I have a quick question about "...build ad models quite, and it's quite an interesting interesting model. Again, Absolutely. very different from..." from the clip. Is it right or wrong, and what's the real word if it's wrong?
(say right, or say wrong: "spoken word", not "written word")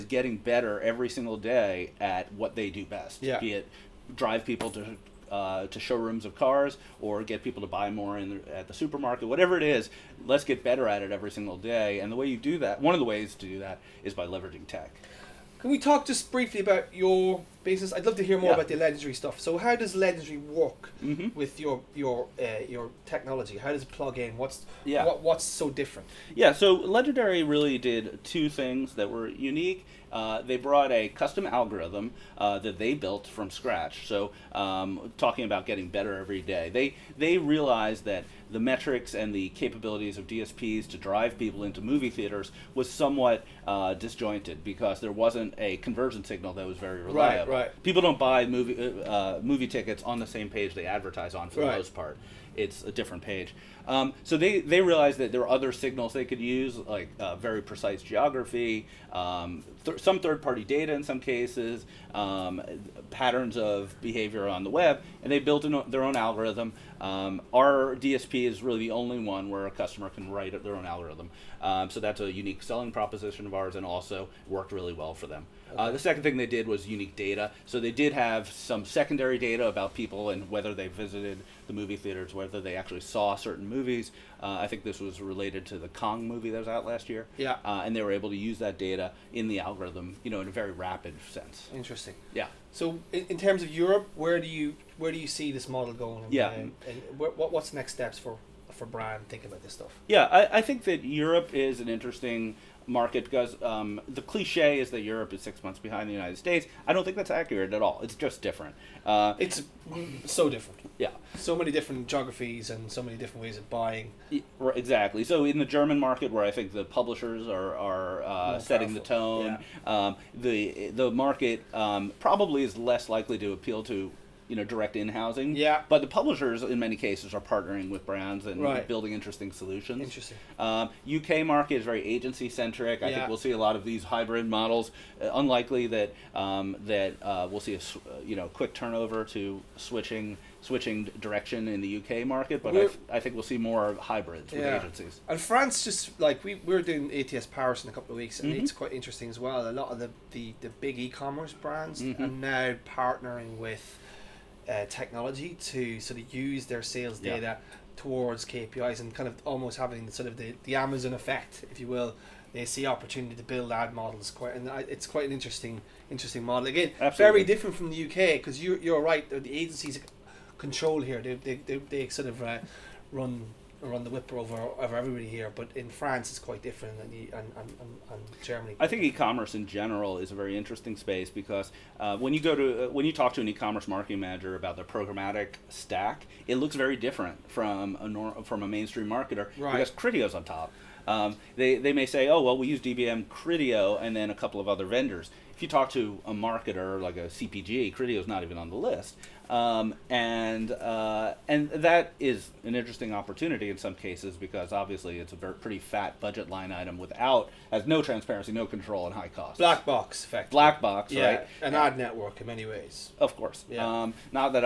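right.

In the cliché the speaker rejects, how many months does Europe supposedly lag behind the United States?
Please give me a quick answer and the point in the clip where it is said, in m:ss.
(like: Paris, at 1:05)
6, at 1:45.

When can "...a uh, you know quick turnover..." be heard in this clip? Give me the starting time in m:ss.
2:17.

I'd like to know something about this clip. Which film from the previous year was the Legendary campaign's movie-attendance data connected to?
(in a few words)
Kong.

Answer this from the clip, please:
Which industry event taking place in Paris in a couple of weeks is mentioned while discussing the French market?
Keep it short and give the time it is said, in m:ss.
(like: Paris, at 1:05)
ATS Paris, at 2:27.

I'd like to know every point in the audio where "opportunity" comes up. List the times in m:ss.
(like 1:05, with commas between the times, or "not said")
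2:42, 3:23.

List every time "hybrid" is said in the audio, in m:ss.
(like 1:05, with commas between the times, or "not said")
2:14, 2:24.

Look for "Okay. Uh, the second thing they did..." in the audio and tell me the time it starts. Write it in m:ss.
1:15.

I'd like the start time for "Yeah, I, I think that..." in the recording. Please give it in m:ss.
1:40.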